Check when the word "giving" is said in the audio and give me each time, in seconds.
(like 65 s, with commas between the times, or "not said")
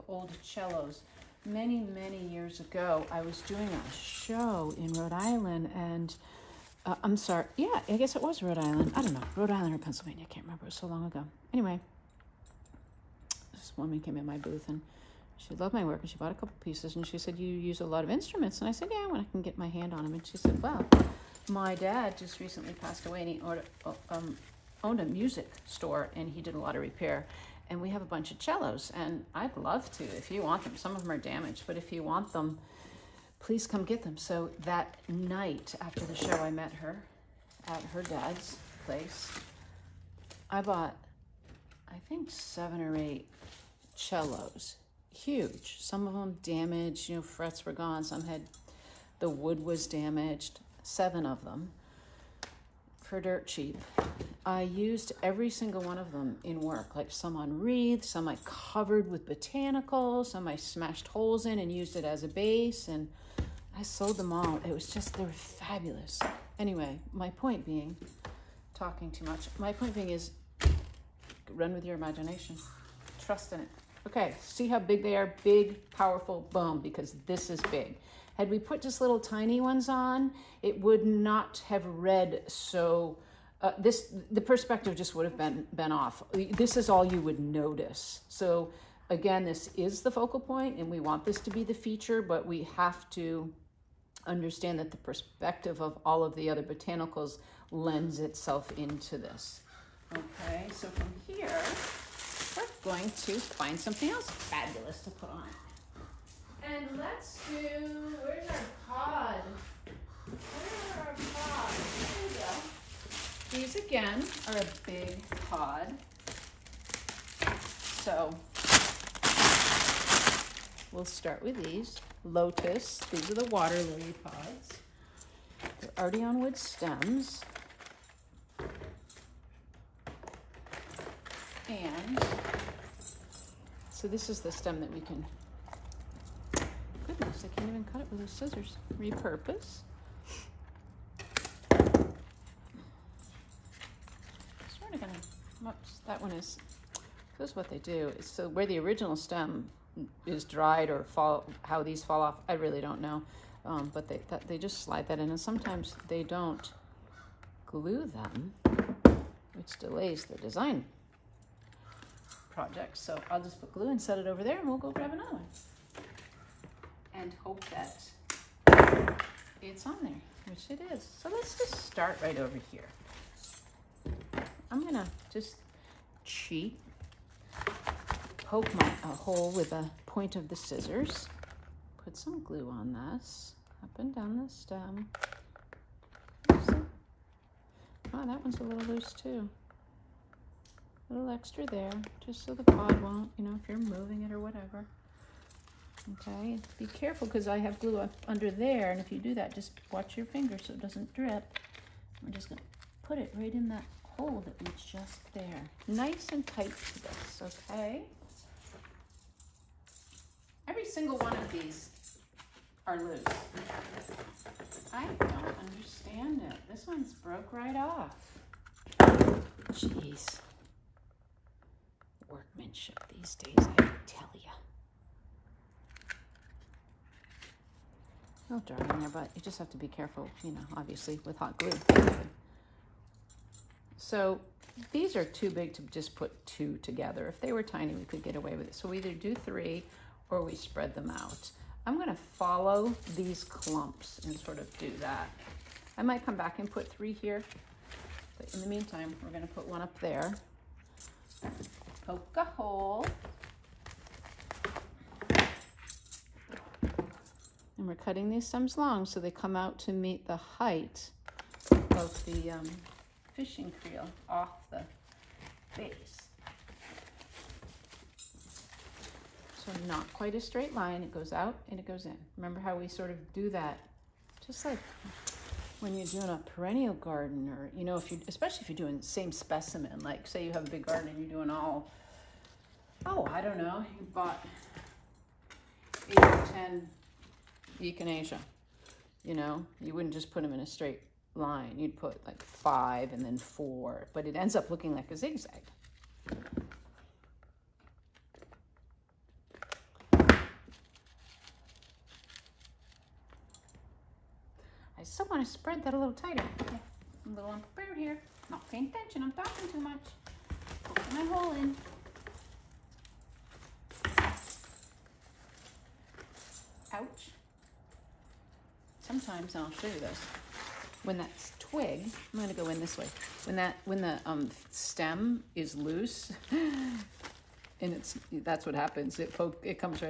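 not said.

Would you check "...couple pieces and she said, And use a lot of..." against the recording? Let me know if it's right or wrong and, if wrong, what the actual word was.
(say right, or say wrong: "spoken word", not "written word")
wrong: "You", not "And".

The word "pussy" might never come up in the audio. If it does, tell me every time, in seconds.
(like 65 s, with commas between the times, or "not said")
not said.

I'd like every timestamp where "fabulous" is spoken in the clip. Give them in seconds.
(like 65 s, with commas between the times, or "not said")
65 s, 104 s.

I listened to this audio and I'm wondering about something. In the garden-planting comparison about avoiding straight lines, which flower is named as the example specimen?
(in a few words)
Echinacea.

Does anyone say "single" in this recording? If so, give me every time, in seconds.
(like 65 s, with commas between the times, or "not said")
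55 s, 210 s.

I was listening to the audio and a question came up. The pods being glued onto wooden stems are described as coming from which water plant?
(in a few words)
Water lily.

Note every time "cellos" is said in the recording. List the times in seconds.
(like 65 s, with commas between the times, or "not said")
0 s, 28 s, 43 s.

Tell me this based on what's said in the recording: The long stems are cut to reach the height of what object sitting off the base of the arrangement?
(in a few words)
Fishing creel.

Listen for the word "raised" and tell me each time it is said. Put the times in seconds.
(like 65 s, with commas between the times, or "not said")
not said.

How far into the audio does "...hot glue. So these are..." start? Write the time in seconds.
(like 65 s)
231 s.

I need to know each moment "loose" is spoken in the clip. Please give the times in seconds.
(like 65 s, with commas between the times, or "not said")
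188 s, 213 s, 325 s.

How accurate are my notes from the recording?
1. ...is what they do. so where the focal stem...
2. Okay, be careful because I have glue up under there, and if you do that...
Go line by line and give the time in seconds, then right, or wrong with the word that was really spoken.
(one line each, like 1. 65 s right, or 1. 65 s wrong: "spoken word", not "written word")
1. 147 s wrong: "original", not "focal"
2. 196 s right.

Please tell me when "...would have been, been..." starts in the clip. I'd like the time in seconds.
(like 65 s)
85 s.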